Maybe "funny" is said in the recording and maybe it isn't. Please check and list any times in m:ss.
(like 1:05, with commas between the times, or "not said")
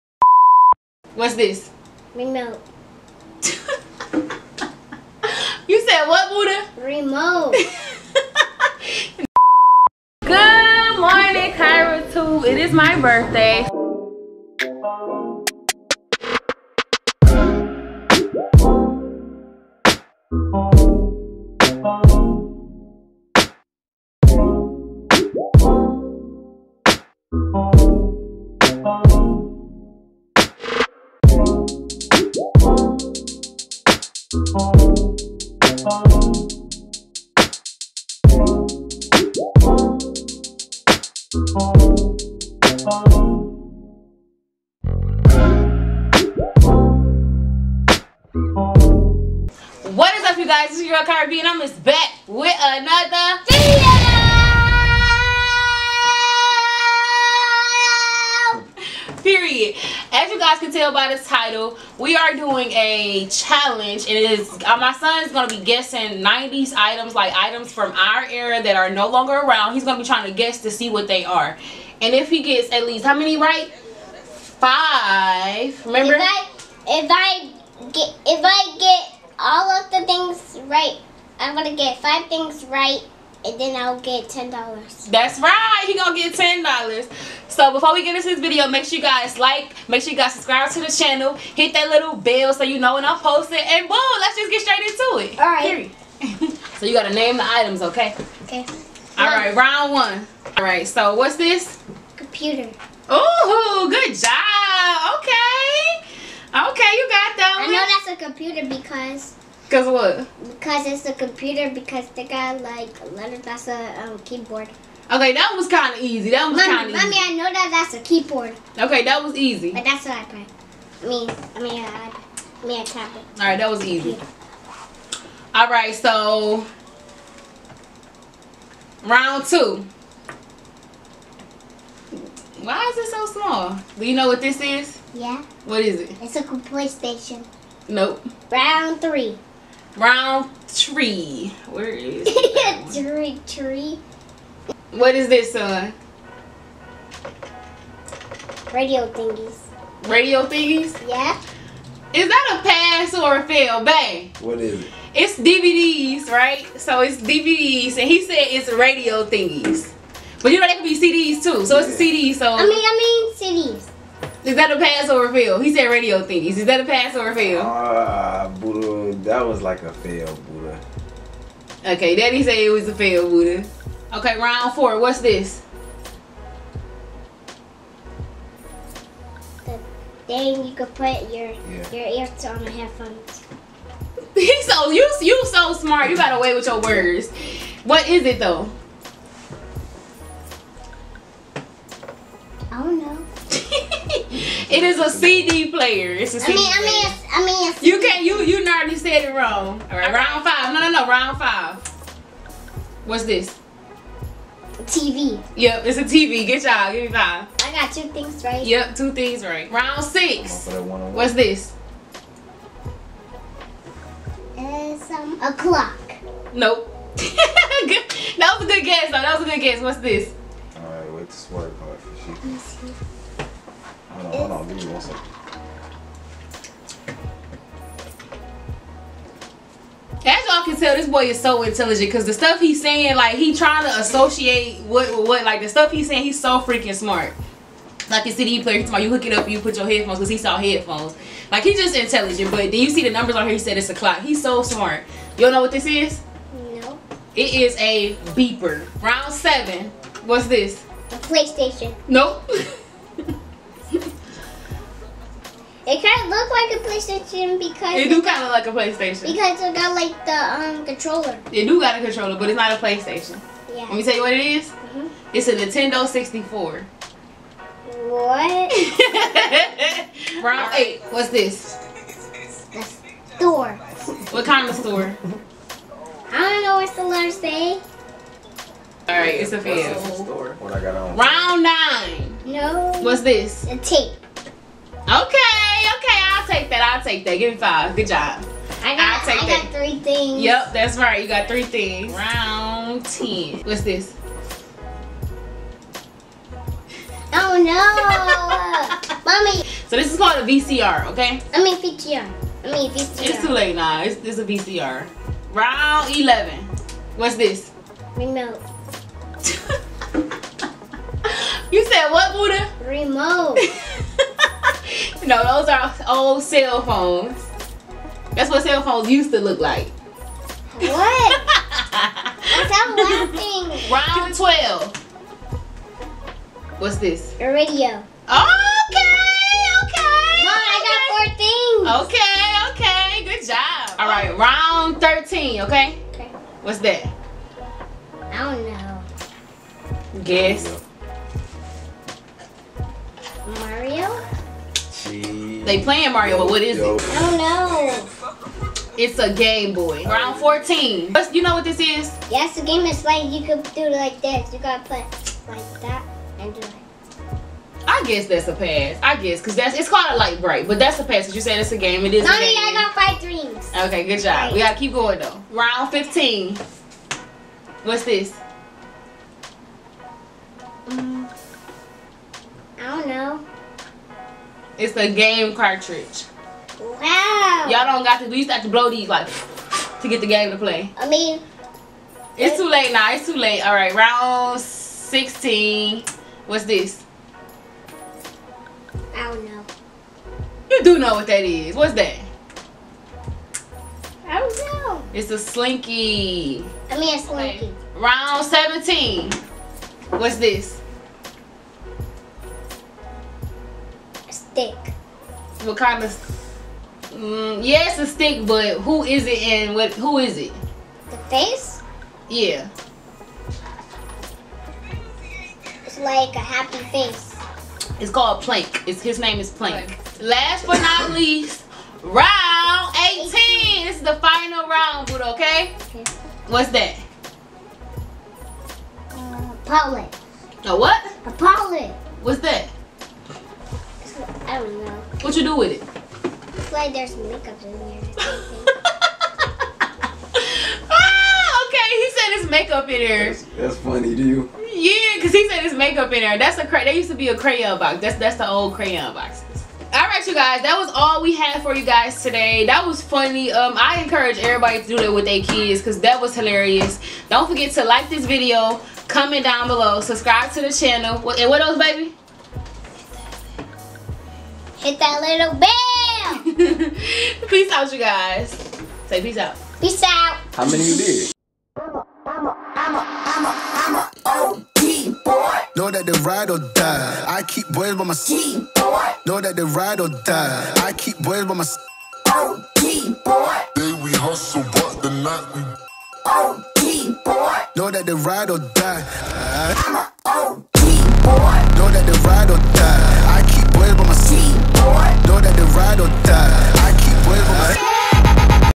7:23, 7:33.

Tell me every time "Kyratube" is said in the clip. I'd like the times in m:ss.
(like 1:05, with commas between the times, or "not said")
0:11.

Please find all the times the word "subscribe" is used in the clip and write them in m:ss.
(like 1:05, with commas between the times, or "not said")
1:30, 7:39.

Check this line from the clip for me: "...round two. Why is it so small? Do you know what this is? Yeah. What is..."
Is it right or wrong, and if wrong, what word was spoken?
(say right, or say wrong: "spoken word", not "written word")
right.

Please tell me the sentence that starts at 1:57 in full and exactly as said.
Mommy, I know that that's a keyboard.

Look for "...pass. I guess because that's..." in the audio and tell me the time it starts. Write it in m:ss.
5:58.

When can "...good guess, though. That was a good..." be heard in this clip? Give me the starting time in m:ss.
3:38.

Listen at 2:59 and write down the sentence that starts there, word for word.
The thing you could put your yeah.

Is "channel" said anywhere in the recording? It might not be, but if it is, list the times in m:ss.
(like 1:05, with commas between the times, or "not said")
1:30, 7:40.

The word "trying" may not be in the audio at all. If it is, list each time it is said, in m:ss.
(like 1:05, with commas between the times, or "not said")
1:10, 3:53.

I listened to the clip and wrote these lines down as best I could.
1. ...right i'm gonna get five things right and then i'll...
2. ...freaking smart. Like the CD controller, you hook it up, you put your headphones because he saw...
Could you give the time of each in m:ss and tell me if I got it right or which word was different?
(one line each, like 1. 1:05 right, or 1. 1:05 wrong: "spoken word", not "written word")
1. 1:20 right
2. 3:56 wrong: "player", not "controller".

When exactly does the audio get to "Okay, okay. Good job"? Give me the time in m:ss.
5:33.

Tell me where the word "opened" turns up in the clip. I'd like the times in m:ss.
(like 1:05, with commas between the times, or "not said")
not said.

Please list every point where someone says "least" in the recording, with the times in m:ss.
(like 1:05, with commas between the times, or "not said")
1:12, 7:01.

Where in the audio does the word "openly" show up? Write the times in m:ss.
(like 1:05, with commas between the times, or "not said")
not said.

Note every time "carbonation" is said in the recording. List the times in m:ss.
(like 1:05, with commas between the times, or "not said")
not said.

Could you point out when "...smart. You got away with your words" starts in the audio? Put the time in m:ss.
3:05.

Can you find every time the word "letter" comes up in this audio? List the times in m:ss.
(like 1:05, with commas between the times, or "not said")
1:53, 4:37.